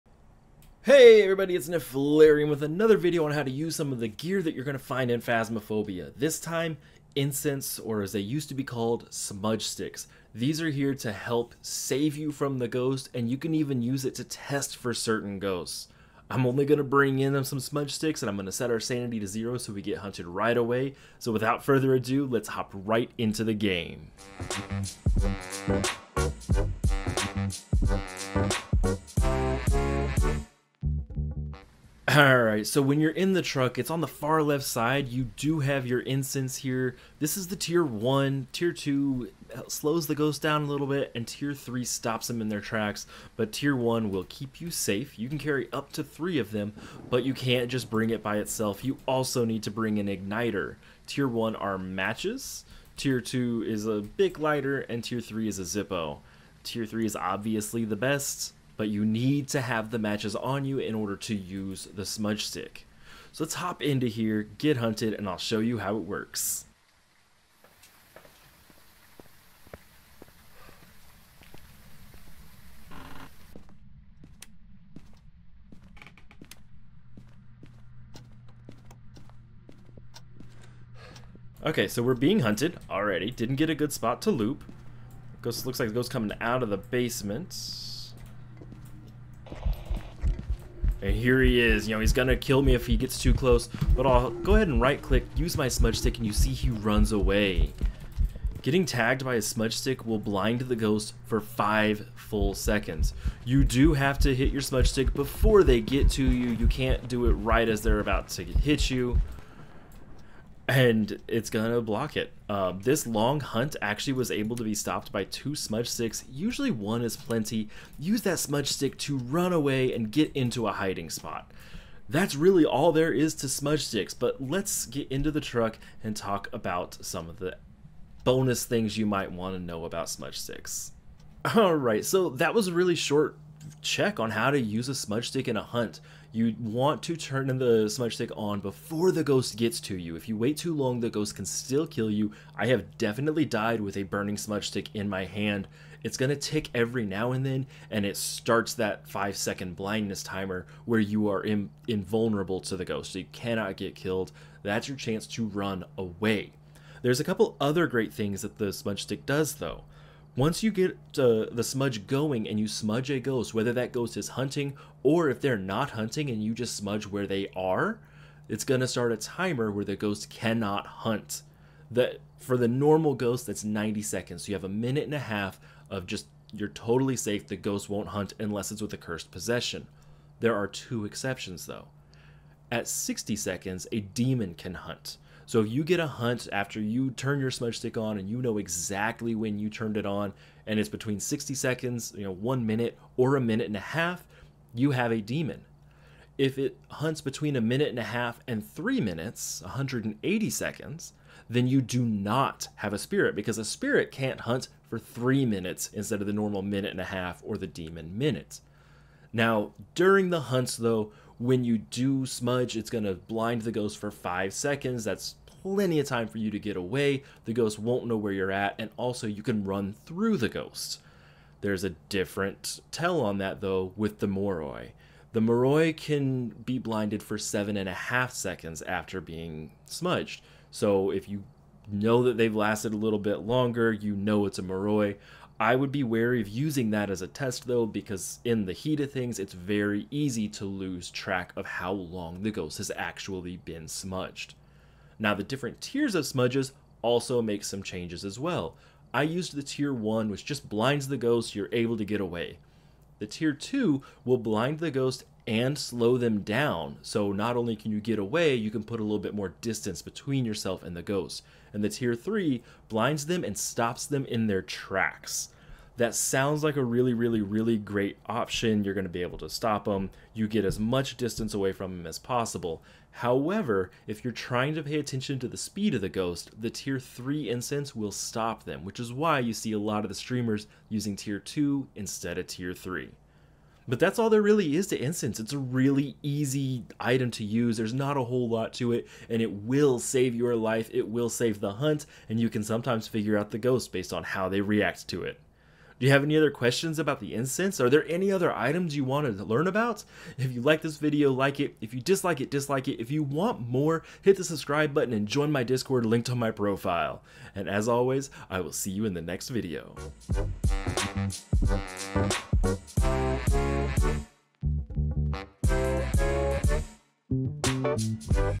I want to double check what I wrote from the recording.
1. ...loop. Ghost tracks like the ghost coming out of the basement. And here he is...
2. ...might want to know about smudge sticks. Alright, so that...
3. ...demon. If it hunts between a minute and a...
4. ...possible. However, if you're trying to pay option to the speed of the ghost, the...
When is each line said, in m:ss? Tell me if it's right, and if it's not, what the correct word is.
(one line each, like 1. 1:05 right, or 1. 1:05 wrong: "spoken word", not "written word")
1. 1:24 wrong: "looks", not "tracks"
2. 2:09 right
3. 3:15 right
4. 4:32 wrong: "attention", not "option".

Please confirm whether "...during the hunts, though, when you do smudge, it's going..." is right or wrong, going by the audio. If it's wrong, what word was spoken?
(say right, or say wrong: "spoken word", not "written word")
right.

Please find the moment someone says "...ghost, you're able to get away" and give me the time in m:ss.
4:11.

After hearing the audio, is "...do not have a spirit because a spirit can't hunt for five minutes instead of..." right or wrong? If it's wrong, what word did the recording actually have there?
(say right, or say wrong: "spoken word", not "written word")
wrong: "three", not "five".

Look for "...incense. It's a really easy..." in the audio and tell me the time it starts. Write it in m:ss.
4:44.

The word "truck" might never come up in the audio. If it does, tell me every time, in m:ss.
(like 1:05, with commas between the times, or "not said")
0:33, 2:05.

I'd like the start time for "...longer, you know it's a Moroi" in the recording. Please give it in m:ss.
3:53.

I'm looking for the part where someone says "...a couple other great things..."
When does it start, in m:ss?
2:37.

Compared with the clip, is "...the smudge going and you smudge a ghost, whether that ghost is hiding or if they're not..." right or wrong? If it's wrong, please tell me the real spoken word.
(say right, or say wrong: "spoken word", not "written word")
wrong: "hunting", not "hiding".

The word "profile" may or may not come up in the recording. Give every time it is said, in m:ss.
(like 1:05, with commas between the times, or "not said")
5:06.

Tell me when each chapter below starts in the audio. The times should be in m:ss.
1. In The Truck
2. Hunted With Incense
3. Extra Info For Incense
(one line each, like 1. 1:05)
1. 0:31
2. 1:20
3. 2:11.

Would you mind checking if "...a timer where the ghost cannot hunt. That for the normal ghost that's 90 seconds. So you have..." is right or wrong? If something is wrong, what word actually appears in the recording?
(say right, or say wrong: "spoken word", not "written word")
right.